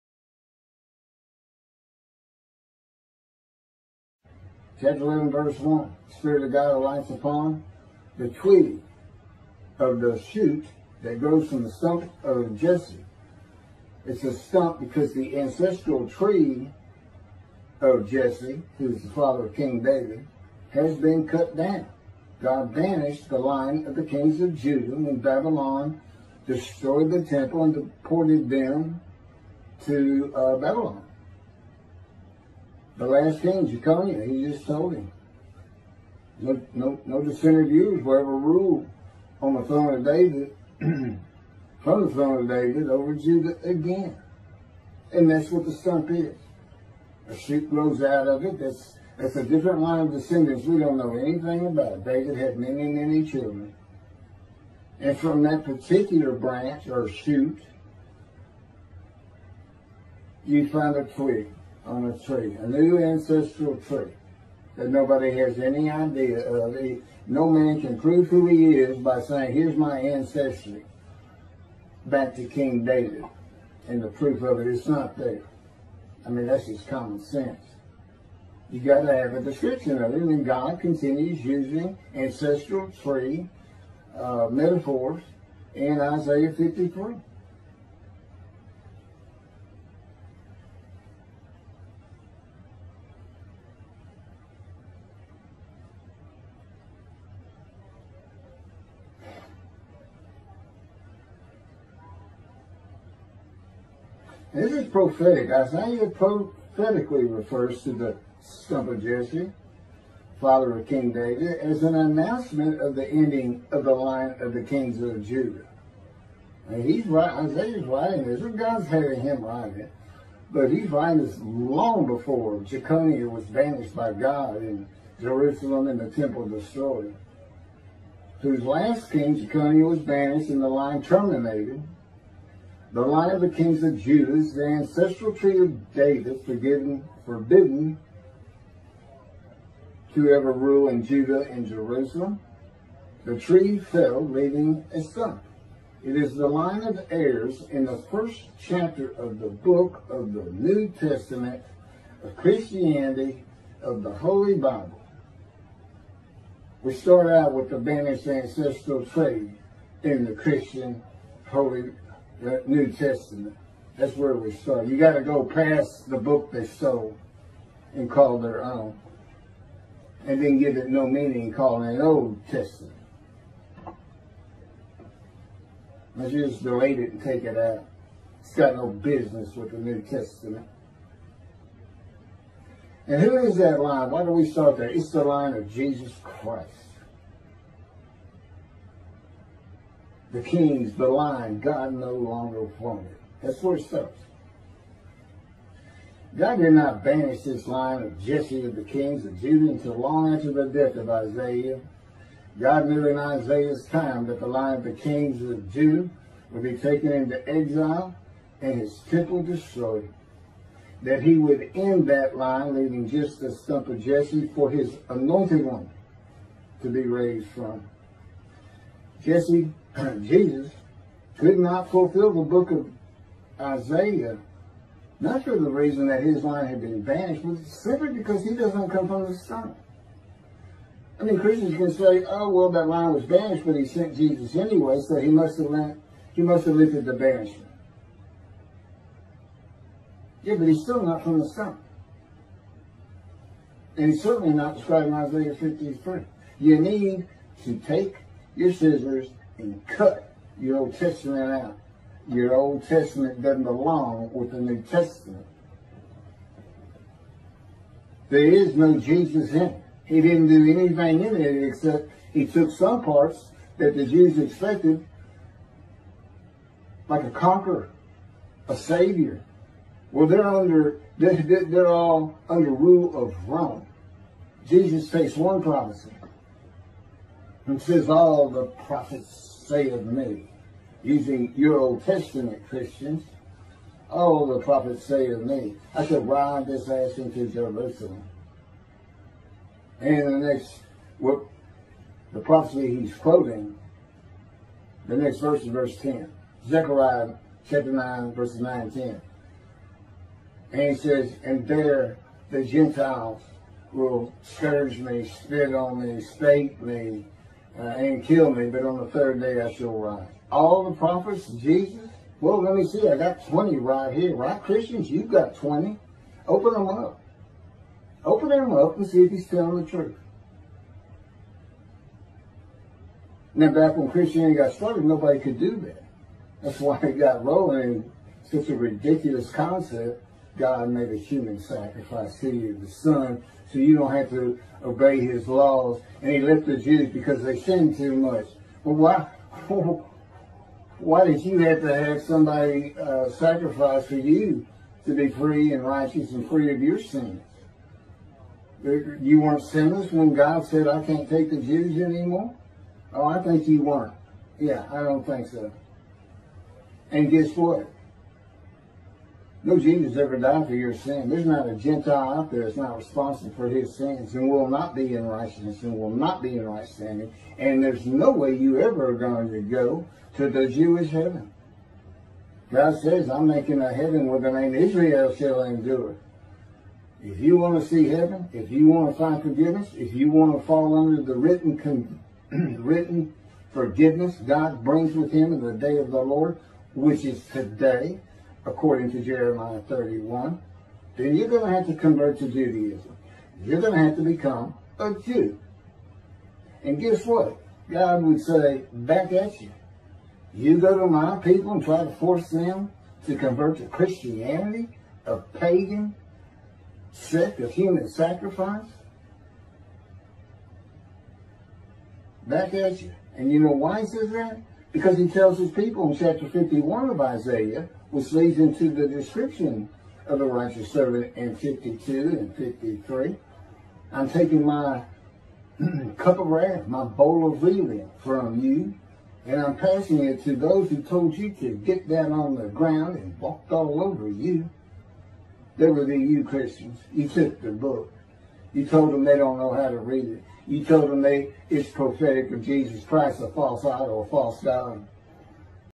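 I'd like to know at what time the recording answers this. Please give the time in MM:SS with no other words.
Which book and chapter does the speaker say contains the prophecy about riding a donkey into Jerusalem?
04:56.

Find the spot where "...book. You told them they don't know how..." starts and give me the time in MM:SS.
07:17.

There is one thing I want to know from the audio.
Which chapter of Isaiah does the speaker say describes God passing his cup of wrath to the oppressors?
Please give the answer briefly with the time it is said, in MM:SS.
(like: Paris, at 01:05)
Chapter 51, at 06:56.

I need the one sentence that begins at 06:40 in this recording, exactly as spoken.
You go to my people and try to force them to convert to Christianity, a pagan sect of human sacrifice?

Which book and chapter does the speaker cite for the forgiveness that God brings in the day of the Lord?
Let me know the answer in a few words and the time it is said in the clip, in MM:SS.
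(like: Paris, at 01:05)
Jeremiah 31, at 06:29.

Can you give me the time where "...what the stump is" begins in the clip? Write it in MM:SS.
00:45.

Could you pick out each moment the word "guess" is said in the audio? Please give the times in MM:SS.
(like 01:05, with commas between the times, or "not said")
05:57, 06:36.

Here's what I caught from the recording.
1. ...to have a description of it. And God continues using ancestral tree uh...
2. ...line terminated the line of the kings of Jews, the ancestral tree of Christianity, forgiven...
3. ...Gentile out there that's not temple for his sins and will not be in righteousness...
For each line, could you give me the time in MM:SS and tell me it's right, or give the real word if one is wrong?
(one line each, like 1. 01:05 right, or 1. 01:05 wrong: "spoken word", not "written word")
1. 01:19 right
2. 02:10 wrong: "David", not "Christianity"
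3. 06:01 wrong: "responsible", not "temple".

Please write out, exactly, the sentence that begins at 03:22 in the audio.
God knew in Isaiah's time that the line of the kings of Judah would be taken into exile and his temple destroyed.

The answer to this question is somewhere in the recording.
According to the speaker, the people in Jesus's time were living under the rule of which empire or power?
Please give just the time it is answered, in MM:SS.
04:33.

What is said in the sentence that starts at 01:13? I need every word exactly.
And the proof of it is not there.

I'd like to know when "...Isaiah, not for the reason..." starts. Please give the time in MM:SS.
03:43.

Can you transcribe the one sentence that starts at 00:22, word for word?
God banished the line of the kings of Judah when Babylon destroyed the temple and deported them to uh, Babylon.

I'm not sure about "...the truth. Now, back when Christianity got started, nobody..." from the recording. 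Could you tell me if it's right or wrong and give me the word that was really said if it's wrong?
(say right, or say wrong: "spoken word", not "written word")
right.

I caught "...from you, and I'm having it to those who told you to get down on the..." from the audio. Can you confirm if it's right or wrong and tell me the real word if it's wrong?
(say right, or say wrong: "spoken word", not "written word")
wrong: "passing", not "having".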